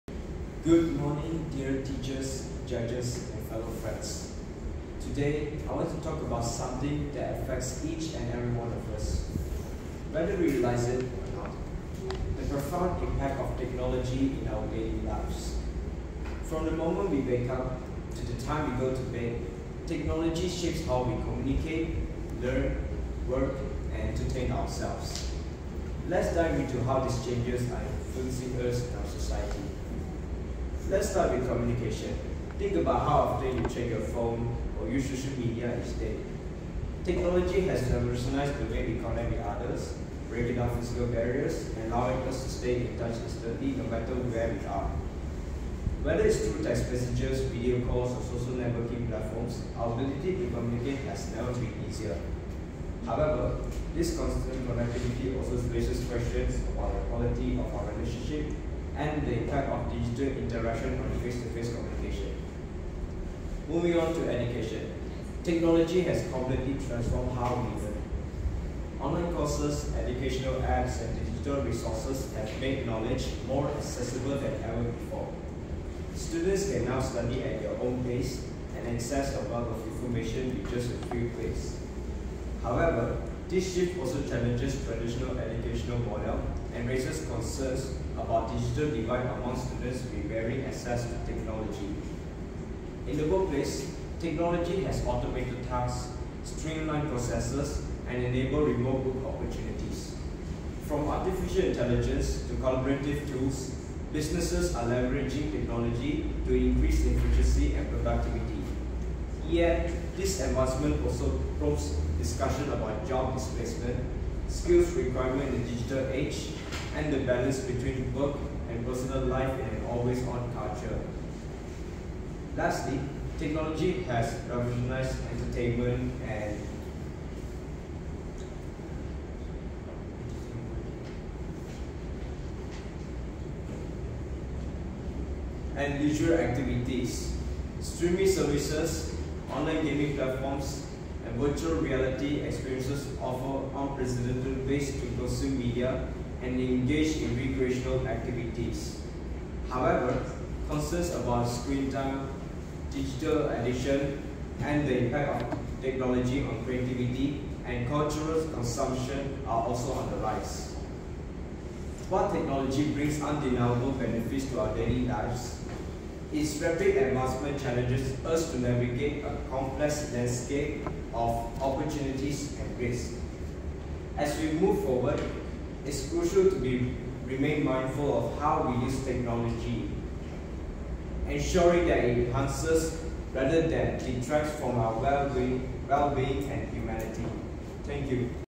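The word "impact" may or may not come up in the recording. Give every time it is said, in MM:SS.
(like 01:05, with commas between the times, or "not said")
00:13, 00:59, 02:35.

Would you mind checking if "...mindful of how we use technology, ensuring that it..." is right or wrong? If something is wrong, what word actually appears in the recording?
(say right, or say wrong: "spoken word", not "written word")
right.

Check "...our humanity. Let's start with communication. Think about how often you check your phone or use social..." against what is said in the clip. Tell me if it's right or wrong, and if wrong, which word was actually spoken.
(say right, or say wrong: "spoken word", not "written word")
wrong: "society", not "humanity".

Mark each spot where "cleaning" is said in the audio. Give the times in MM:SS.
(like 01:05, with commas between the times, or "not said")
not said.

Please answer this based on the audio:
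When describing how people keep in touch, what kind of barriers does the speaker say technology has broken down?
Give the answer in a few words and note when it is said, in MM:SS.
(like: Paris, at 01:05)
Physical barriers, at 00:40.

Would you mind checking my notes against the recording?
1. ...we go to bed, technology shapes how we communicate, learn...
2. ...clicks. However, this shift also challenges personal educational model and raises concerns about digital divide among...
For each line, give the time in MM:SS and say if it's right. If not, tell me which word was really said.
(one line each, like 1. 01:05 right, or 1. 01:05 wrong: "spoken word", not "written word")
1. 00:18 right
2. 01:21 wrong: "traditional", not "personal".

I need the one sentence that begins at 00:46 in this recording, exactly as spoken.
Whether it's through text messages, video calls, or social networking platforms, our ability to communicate has never been easier.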